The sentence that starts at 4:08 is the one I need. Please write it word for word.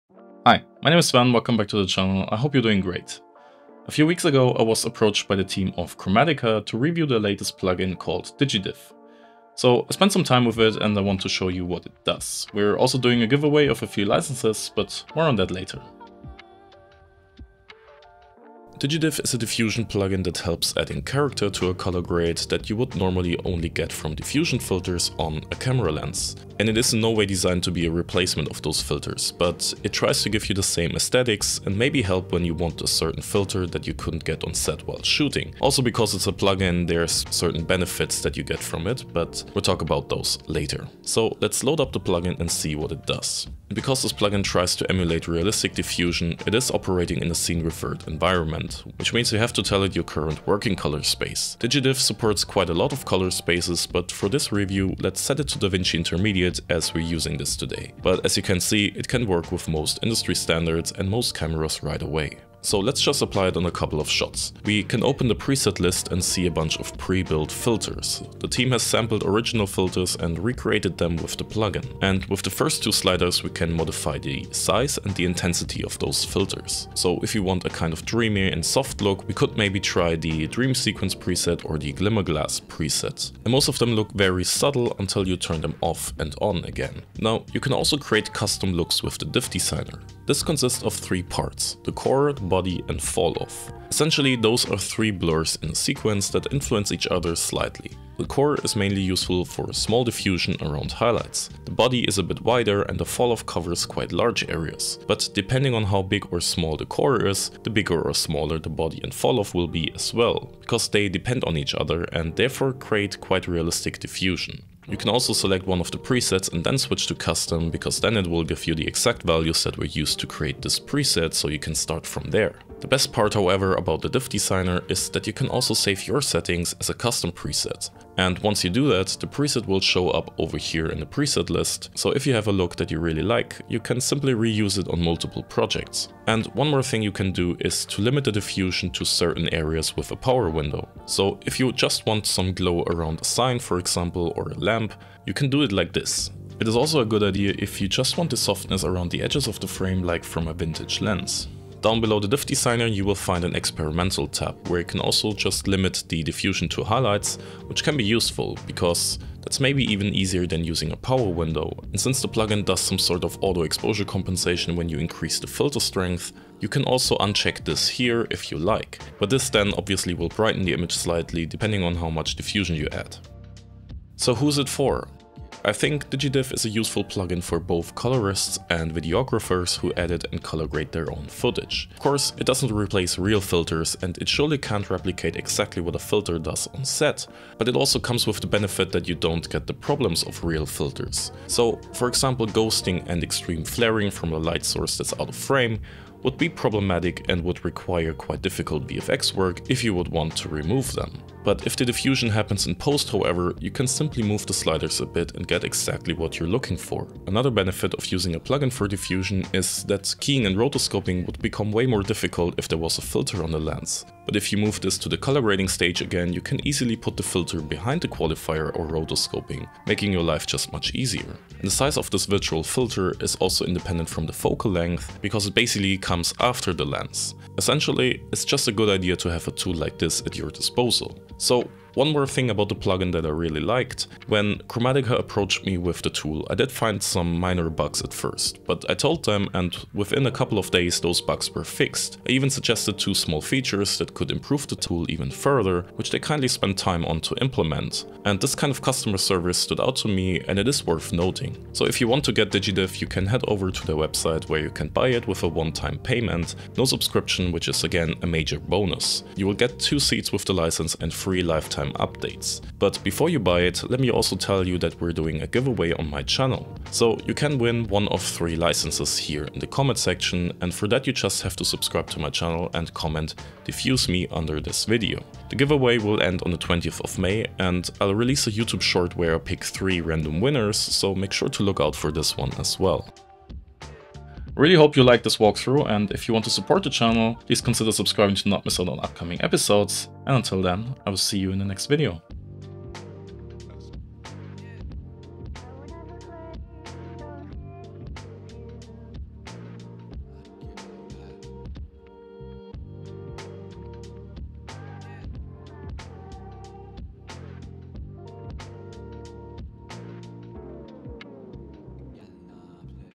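And this kind of customer service stood out to me and it is worth noting.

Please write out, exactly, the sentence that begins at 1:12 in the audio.
And with the first two sliders we can modify the size and the intensity of those filters.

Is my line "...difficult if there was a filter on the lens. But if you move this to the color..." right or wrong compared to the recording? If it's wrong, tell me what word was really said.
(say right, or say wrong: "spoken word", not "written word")
right.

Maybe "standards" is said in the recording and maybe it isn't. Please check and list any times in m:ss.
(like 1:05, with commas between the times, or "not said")
1:00.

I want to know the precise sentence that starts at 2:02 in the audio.
The best part however about the diff designer is that you can also save your settings as a custom preset.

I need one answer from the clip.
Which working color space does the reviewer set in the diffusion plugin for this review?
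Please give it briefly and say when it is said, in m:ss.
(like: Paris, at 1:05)
DaVinci Intermediate, at 0:55.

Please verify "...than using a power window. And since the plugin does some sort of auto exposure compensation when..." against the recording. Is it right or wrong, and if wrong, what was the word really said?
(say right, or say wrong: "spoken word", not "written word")
right.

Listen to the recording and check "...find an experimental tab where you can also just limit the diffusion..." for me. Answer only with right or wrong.
right.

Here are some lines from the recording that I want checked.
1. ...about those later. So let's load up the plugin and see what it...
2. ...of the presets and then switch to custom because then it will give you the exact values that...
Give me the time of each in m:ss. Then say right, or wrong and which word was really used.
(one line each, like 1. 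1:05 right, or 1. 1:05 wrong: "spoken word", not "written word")
1. 0:39 right
2. 1:55 right.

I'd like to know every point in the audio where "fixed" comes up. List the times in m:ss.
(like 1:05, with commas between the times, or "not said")
4:01.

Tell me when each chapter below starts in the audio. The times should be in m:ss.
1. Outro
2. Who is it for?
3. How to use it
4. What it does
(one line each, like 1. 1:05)
1. 4:44
2. 2:54
3. 1:03
4. 0:17.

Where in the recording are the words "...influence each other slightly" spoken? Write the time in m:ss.
1:36.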